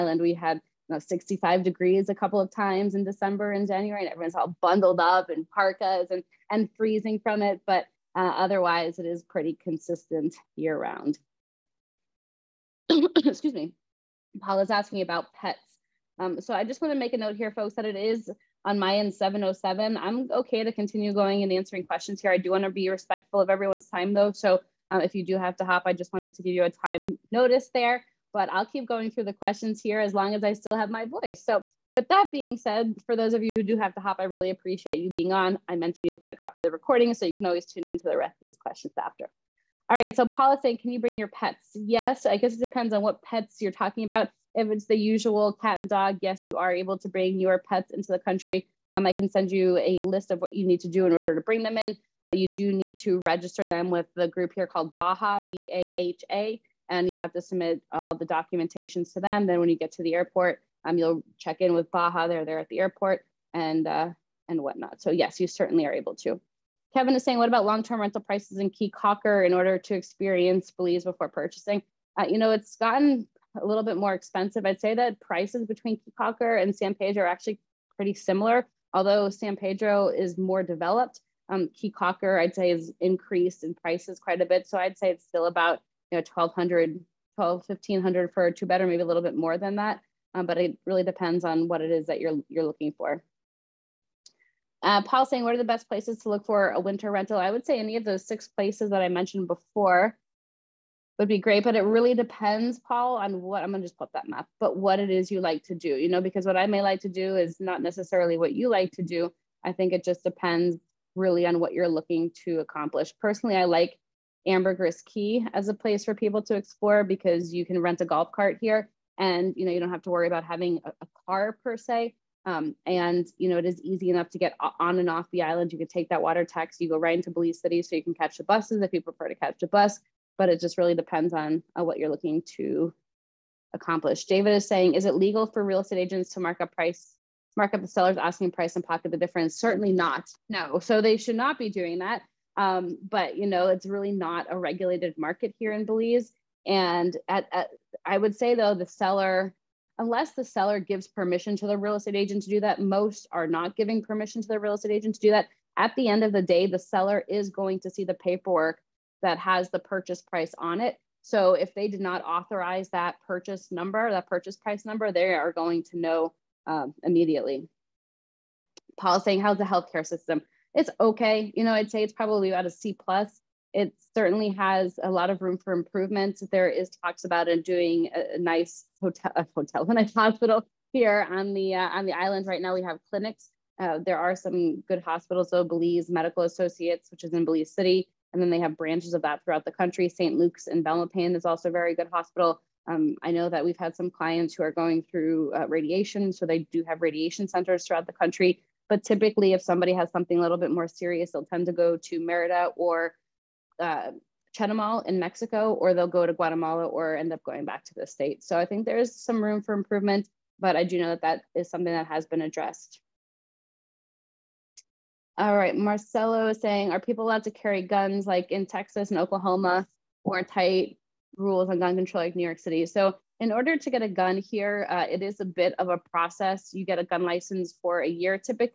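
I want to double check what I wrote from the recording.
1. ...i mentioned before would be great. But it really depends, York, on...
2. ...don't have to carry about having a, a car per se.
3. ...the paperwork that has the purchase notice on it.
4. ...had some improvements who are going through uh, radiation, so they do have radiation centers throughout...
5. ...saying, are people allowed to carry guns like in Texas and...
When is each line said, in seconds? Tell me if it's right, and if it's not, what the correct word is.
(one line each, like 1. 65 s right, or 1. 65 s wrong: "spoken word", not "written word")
1. 99 s wrong: "Paul", not "York"
2. 119 s wrong: "worry", not "carry"
3. 158 s wrong: "price", not "notice"
4. 193 s wrong: "clients", not "improvements"
5. 216 s right.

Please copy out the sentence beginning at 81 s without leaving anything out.
Um, Caye Caulker, I'd say, is increased in prices quite a bit.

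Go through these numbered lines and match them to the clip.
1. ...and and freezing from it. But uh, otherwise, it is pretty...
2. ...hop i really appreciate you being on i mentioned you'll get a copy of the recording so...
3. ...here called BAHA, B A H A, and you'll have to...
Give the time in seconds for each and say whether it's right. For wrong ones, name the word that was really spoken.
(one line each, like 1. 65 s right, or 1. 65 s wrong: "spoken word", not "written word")
1. 6 s right
2. 34 s right
3. 54 s right.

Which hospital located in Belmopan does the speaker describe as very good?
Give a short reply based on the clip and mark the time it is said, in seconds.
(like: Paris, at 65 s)
St. Luke's, at 190 s.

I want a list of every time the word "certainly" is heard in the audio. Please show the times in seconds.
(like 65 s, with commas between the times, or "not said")
65 s, 139 s, 174 s.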